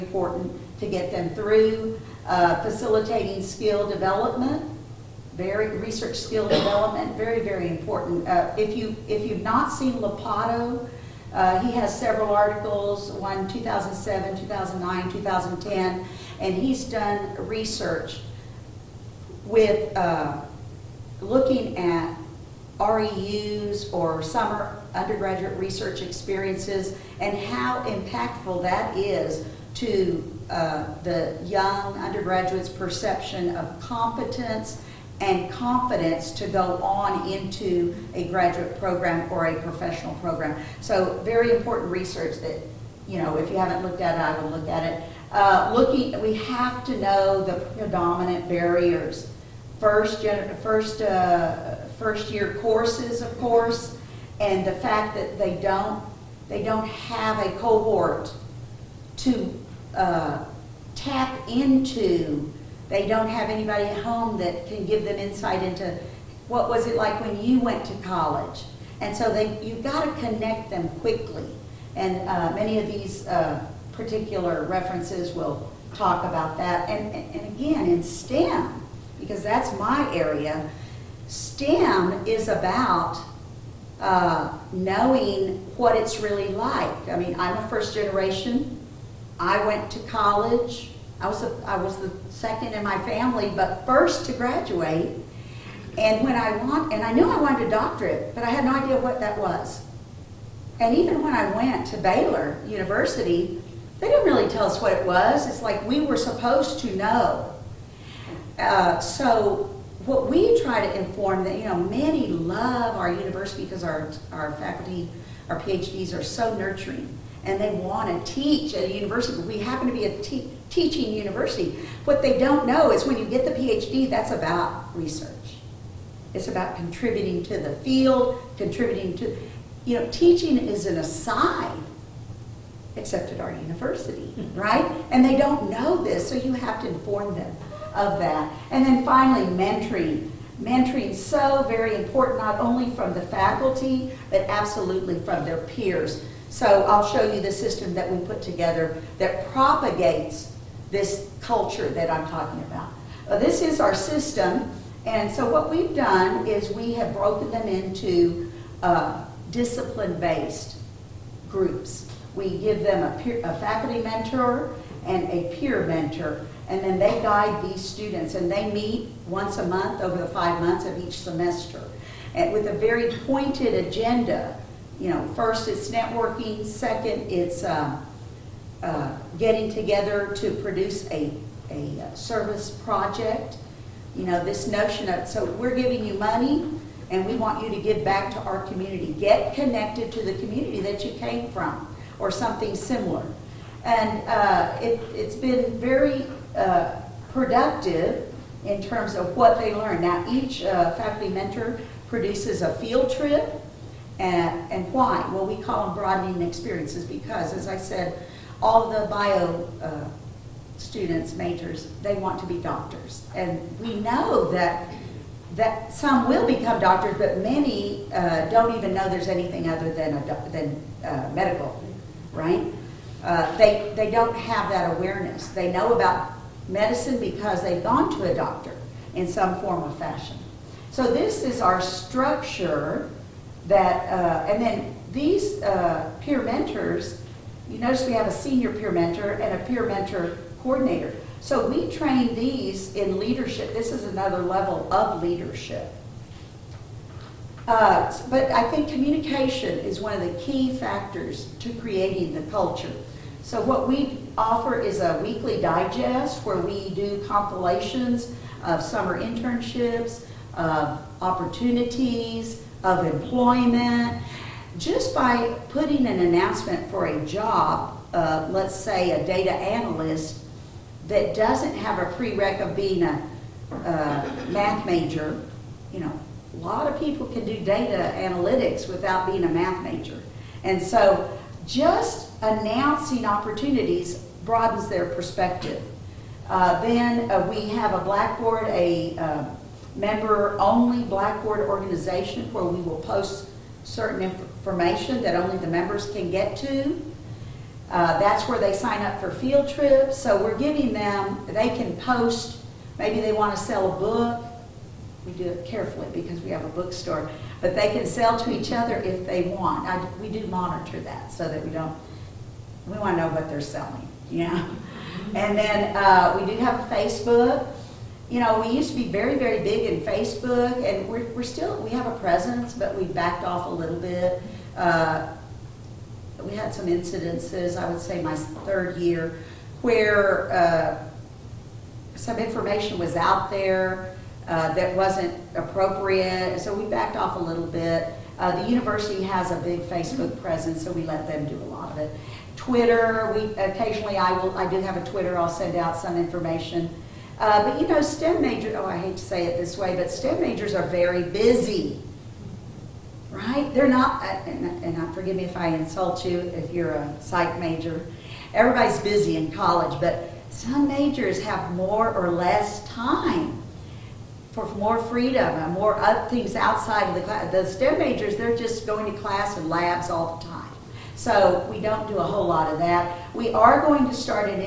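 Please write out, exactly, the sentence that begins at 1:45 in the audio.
It's like we were supposed to know.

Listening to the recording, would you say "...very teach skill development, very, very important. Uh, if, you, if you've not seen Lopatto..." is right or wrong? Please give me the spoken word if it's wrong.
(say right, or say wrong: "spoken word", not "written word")
wrong: "research", not "teach".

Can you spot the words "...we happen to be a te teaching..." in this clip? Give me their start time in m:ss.
1:59.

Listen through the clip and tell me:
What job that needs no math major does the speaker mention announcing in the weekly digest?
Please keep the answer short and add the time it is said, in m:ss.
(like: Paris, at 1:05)
data analyst, at 4:29.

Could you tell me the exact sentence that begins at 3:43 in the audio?
Uh, they, they don't have that awareness.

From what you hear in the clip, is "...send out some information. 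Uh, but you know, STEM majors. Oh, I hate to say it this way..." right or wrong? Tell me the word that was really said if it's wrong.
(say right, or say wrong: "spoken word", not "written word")
right.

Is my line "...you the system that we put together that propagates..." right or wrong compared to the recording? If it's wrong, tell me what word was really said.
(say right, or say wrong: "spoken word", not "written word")
right.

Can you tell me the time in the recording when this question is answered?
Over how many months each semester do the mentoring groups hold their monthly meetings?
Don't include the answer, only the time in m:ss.
2:50.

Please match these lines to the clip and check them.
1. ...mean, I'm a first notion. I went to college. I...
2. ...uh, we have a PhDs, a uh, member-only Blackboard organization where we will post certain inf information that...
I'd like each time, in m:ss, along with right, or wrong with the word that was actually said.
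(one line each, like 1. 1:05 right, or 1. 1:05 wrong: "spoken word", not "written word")
1. 1:27 wrong: "generation", not "notion"
2. 4:47 wrong: "Blackboard", not "PhDs".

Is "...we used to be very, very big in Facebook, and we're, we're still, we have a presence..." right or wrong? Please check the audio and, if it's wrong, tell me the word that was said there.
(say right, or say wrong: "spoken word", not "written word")
right.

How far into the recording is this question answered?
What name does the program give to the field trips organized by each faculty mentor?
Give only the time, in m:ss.
3:25.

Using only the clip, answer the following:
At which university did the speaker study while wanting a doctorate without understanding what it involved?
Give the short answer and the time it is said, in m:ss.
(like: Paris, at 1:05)
Baylor University, at 1:41.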